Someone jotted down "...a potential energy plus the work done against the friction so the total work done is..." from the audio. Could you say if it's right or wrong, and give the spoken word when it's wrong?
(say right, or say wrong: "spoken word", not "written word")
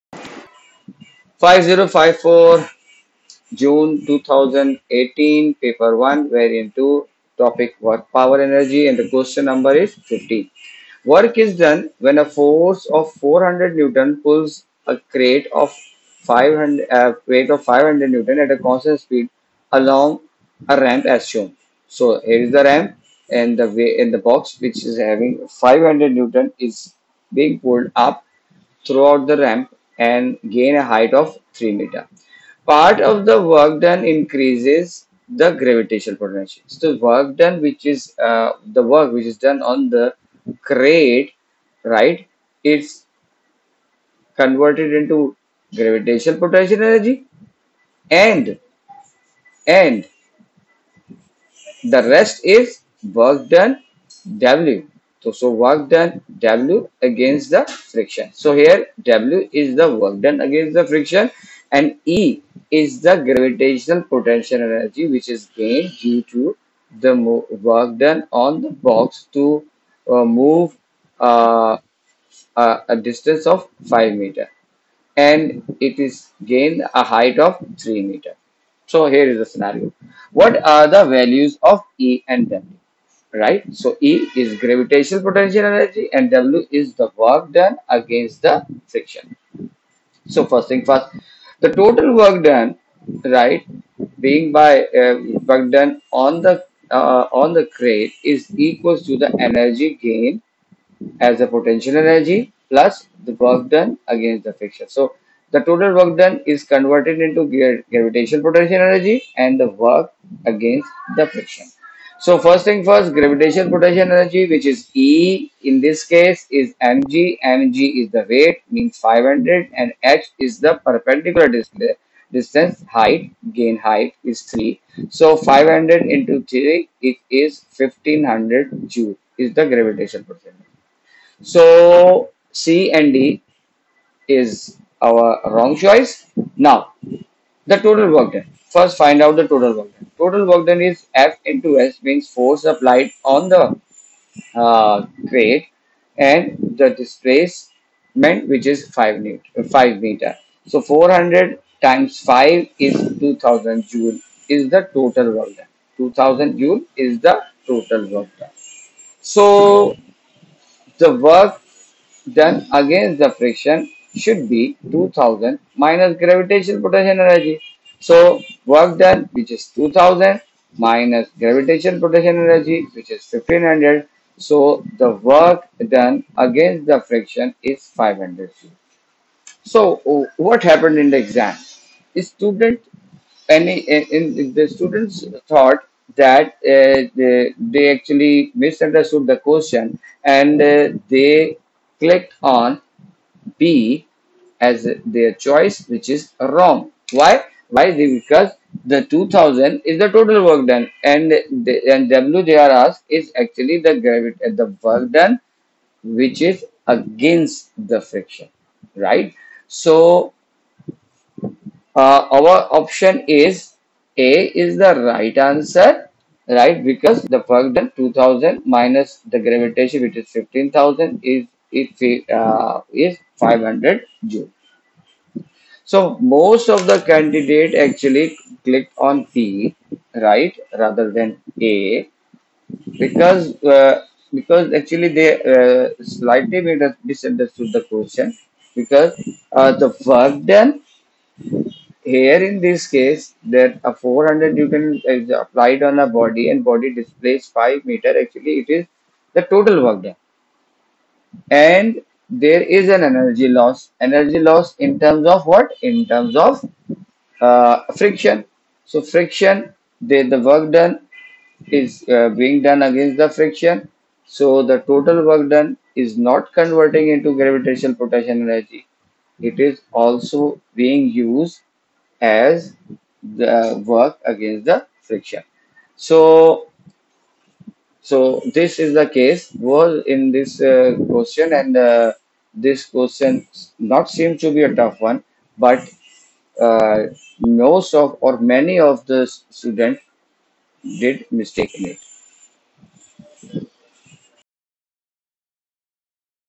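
right.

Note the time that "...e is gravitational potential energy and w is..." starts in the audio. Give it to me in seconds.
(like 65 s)
84 s.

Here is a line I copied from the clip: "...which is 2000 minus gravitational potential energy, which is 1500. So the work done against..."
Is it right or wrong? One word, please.
right.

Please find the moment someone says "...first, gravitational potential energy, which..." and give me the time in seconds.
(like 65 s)
112 s.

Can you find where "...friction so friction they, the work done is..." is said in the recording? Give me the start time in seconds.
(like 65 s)
257 s.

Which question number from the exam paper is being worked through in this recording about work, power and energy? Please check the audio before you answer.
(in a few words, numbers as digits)
15.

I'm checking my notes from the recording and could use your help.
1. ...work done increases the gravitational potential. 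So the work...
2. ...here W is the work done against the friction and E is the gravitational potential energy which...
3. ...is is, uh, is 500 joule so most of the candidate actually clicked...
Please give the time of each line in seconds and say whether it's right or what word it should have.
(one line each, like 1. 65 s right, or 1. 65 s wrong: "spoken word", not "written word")
1. 33 s right
2. 58 s right
3. 221 s right.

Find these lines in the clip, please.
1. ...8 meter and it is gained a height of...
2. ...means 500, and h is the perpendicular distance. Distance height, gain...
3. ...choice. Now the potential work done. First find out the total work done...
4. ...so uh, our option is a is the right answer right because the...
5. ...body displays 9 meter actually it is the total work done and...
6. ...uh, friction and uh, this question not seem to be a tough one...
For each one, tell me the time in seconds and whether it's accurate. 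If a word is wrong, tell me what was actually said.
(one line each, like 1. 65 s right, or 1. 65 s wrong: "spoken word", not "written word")
1. 73 s wrong: "5", not "8"
2. 118 s right
3. 135 s wrong: "total", not "potential"
4. 209 s right
5. 246 s wrong: "5", not "9"
6. 280 s wrong: "question", not "friction".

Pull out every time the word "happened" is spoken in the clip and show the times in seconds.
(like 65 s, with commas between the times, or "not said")
180 s.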